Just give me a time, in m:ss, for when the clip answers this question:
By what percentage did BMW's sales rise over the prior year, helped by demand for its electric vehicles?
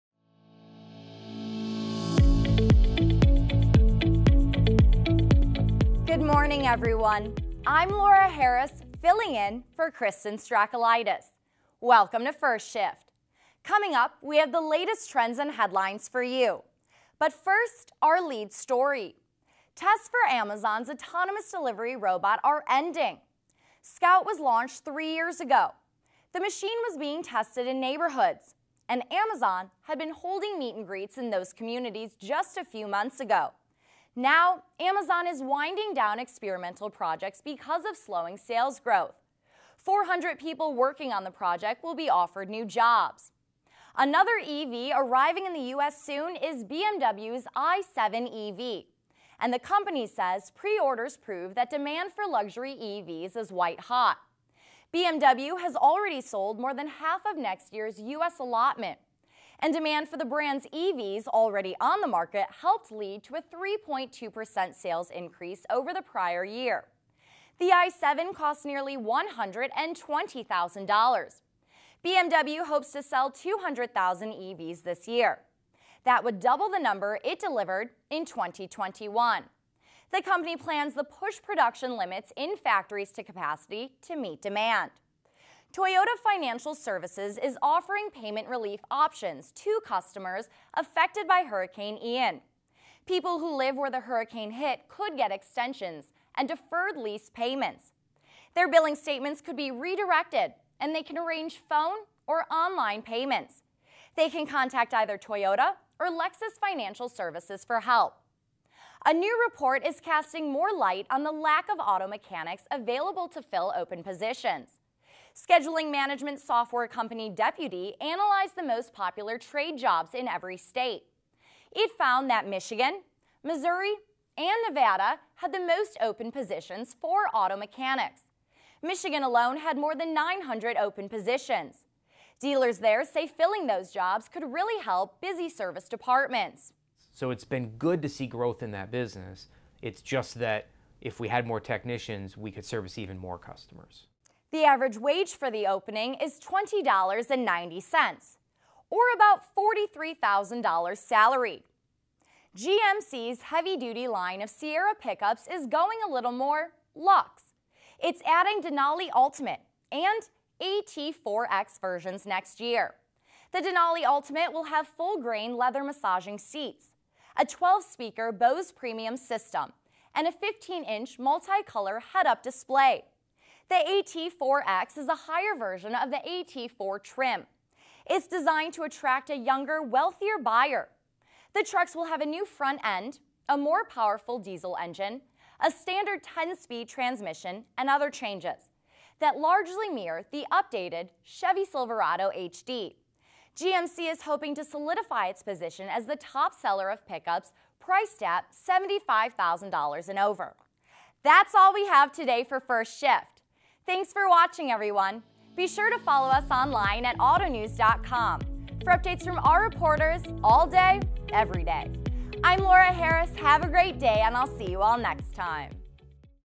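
1:03.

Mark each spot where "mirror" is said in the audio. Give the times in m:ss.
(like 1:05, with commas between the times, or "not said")
3:09.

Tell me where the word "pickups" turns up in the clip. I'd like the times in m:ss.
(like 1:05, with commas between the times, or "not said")
2:34, 3:17.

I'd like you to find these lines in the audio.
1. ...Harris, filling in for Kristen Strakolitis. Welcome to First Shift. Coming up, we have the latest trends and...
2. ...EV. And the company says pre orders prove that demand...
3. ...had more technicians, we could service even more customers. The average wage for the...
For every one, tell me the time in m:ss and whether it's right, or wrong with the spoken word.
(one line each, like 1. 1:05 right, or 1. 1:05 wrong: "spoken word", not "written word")
1. 0:08 right
2. 0:48 right
3. 2:21 right.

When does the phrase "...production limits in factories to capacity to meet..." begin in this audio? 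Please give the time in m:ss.
1:21.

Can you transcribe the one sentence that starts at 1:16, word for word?
That would double the number it delivered in 2021.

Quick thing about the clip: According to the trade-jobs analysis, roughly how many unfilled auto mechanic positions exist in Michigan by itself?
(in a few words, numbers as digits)
more than 900.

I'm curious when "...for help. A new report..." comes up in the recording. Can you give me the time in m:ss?
1:47.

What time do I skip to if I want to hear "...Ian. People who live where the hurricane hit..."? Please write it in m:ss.
1:32.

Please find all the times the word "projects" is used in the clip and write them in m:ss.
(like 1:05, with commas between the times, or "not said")
0:36, 0:41.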